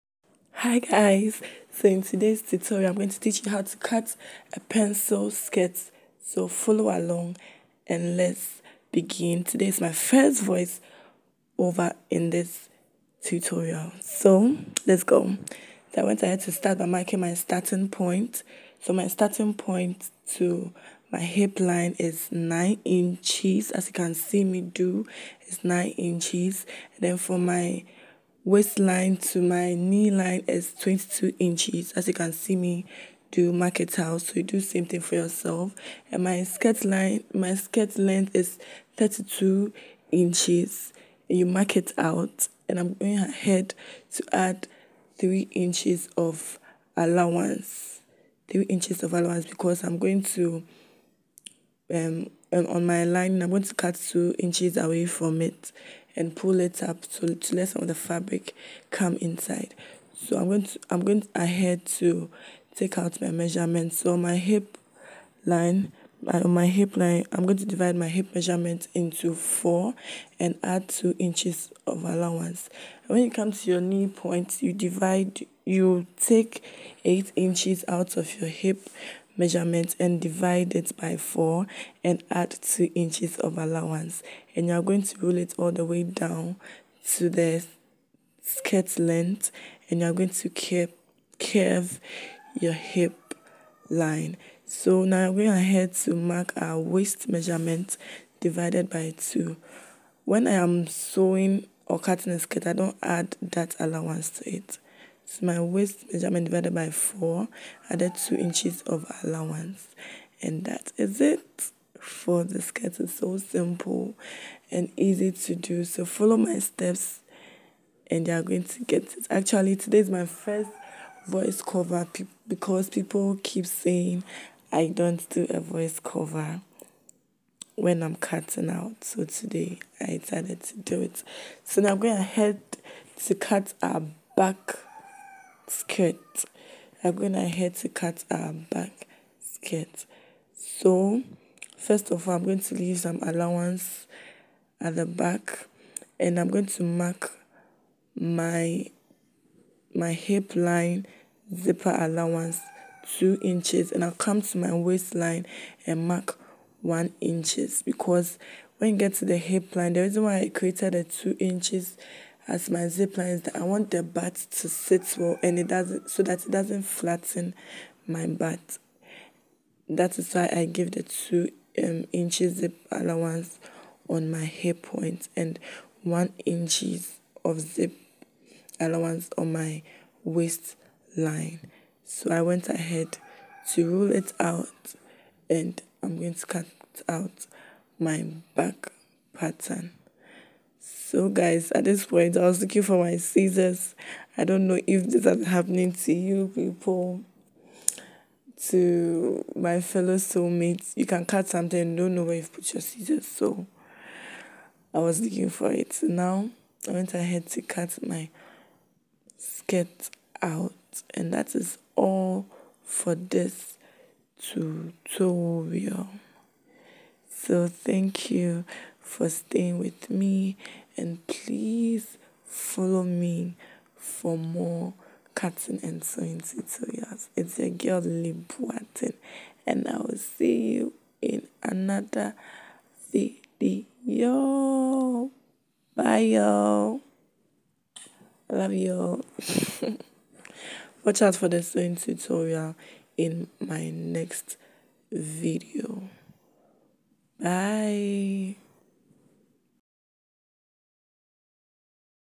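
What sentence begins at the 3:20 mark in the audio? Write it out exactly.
You can cut something and don't know where you've put your scissors.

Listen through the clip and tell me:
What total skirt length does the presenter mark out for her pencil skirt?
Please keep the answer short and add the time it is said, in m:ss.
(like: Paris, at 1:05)
32 inches, at 0:38.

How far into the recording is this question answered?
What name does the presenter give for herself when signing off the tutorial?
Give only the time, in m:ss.
3:48.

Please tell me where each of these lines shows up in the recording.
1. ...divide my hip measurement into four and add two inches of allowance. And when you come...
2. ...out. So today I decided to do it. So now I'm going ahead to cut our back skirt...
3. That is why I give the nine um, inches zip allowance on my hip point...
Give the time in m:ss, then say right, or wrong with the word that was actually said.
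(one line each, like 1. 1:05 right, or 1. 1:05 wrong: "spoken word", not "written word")
1. 1:07 right
2. 2:08 right
3. 2:49 wrong: "two", not "nine".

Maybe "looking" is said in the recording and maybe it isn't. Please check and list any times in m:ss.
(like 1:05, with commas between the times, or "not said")
3:12, 3:25.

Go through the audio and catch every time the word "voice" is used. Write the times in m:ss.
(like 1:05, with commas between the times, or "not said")
0:10, 2:01, 2:05.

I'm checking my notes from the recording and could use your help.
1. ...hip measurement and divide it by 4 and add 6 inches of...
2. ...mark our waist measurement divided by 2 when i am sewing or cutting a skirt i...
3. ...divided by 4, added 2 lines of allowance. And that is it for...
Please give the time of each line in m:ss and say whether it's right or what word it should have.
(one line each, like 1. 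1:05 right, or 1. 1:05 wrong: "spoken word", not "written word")
1. 1:18 wrong: "2", not "6"
2. 1:36 right
3. 1:46 wrong: "inches", not "lines".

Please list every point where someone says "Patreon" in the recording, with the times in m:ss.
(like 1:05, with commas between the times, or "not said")
not said.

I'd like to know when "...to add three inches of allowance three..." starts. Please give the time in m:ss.
0:44.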